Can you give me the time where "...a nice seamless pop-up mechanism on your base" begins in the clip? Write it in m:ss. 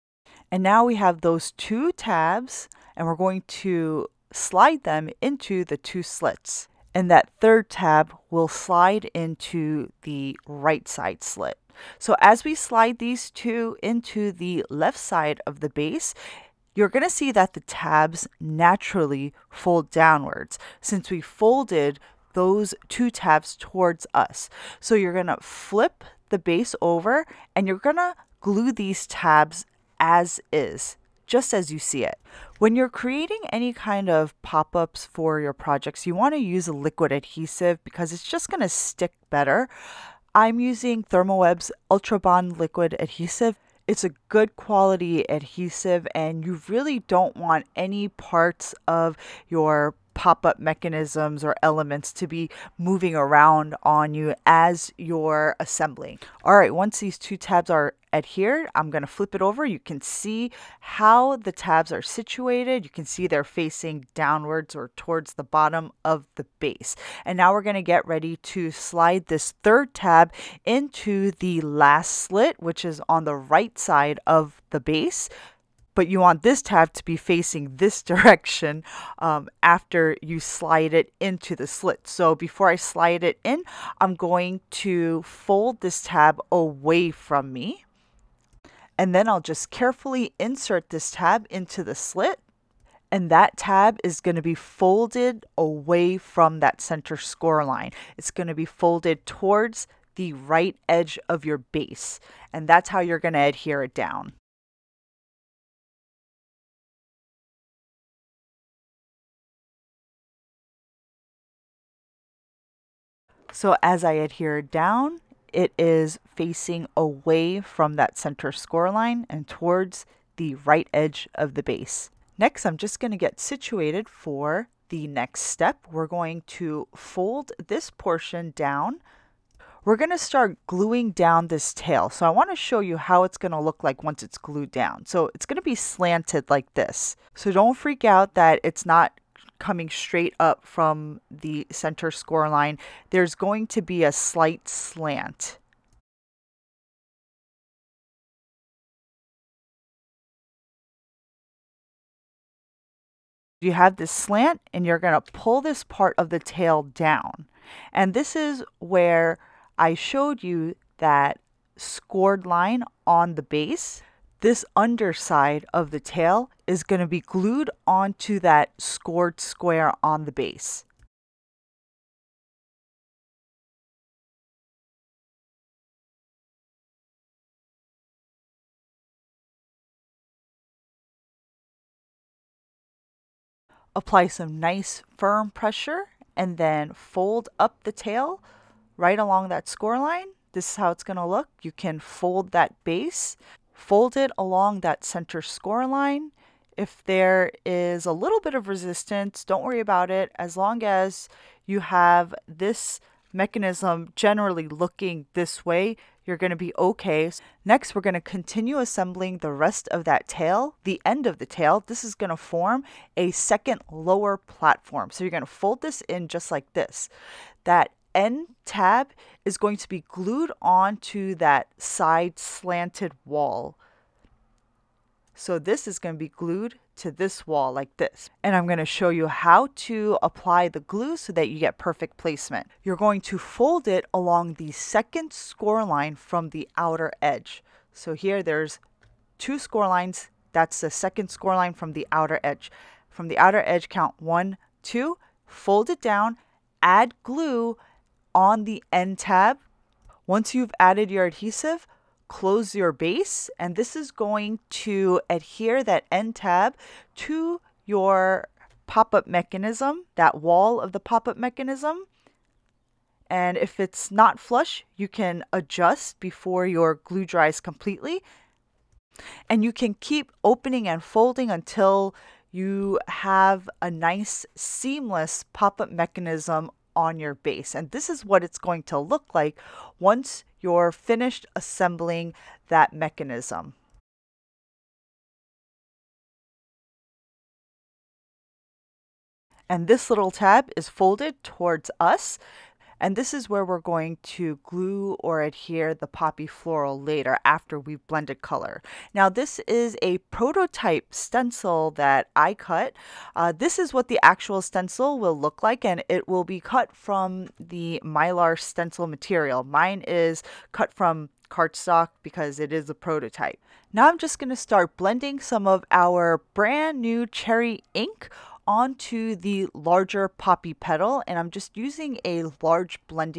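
4:33.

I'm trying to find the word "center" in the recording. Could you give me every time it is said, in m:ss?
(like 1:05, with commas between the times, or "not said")
1:36, 1:58, 2:21, 3:15.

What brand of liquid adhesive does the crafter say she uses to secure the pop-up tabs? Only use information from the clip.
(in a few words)
Ultrabond.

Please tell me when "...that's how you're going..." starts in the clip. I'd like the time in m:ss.
1:42.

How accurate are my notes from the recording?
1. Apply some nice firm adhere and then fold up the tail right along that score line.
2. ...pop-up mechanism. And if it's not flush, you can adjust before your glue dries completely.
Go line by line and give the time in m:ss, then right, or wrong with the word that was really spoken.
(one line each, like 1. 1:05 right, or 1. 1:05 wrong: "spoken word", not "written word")
1. 3:03 wrong: "pressure", not "adhere"
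2. 4:20 right.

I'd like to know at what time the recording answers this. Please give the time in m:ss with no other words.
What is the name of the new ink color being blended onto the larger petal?
5:17.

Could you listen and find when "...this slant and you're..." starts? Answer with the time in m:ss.
2:33.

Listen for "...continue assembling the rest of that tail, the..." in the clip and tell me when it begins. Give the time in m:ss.
3:28.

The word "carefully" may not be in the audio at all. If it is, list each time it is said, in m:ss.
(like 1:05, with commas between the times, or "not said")
1:29.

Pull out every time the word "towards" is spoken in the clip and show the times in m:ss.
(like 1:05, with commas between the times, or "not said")
0:23, 1:04, 1:39, 1:59, 4:51.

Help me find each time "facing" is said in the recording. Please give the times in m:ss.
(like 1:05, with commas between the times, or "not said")
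1:03, 1:17, 1:56.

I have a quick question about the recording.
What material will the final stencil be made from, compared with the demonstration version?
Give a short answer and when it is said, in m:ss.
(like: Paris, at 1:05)
mylar, at 5:08.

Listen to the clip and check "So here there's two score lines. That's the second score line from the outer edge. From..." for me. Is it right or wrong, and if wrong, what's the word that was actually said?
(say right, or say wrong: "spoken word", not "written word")
right.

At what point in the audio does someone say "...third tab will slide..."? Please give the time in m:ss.
0:07.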